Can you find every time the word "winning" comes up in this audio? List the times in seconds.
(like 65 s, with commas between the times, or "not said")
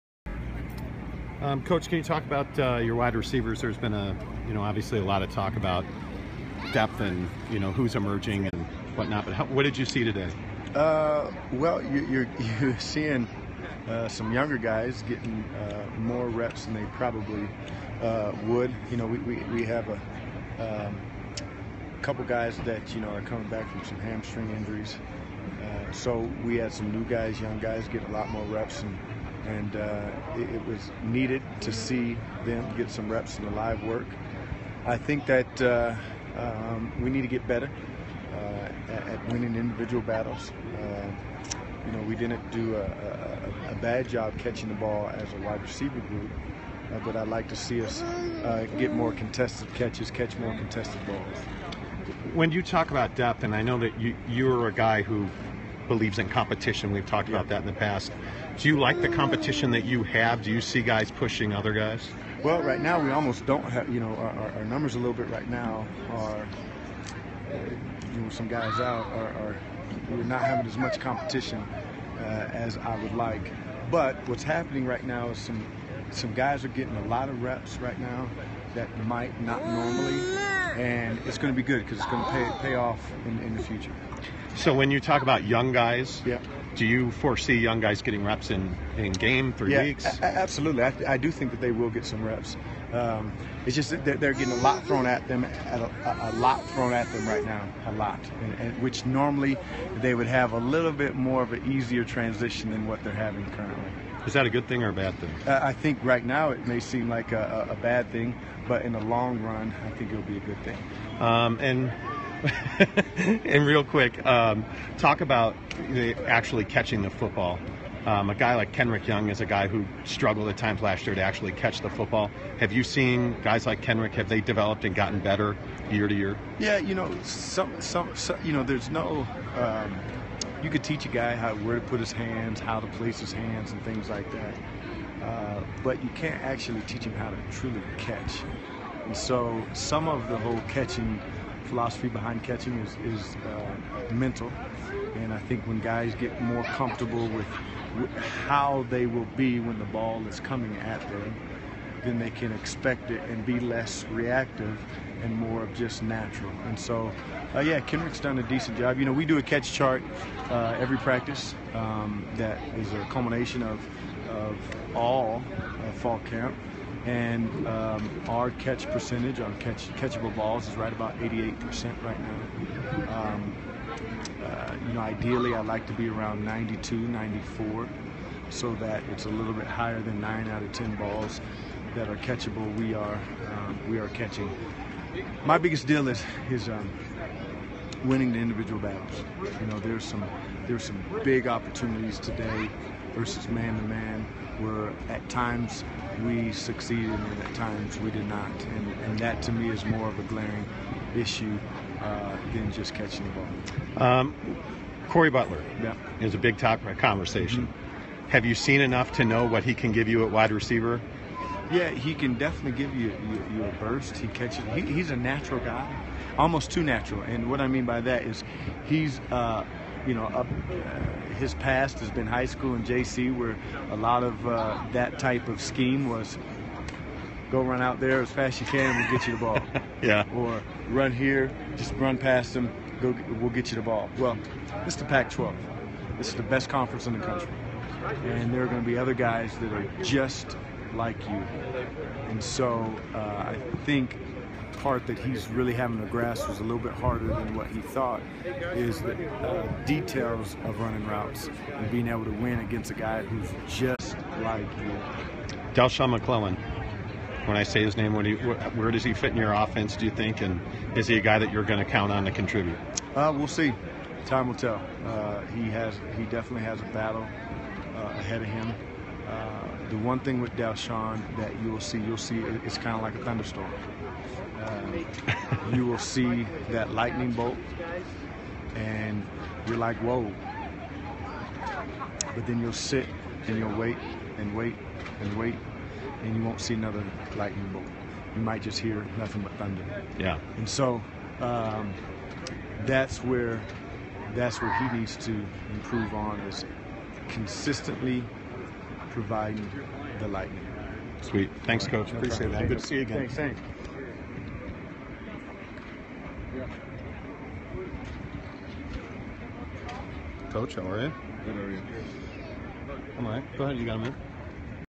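39 s, 188 s.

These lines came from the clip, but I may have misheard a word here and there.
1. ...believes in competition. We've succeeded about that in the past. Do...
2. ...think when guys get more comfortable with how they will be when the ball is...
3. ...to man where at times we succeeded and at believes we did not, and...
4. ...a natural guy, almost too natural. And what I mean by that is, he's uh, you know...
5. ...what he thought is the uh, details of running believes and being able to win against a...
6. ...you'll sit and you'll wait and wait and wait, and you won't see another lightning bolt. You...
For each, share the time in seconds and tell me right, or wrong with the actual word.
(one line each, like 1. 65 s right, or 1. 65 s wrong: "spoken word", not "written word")
1. 55 s wrong: "talked", not "succeeded"
2. 145 s right
3. 193 s wrong: "times", not "believes"
4. 215 s right
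5. 247 s wrong: "routes", not "believes"
6. 282 s right.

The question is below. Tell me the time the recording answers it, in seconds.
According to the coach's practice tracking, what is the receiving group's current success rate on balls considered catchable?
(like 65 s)
171 s.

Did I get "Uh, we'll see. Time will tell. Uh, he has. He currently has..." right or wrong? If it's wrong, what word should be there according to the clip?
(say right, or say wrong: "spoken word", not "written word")
wrong: "definitely", not "currently".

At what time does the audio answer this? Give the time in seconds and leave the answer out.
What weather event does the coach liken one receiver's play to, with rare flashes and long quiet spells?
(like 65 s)
273 s.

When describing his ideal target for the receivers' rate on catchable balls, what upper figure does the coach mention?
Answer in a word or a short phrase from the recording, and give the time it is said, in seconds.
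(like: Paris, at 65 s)
94, at 176 s.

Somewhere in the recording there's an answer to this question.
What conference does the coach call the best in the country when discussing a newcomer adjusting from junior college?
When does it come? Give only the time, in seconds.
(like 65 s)
235 s.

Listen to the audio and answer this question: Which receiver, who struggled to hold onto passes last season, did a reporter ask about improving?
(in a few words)
Kenrick Young.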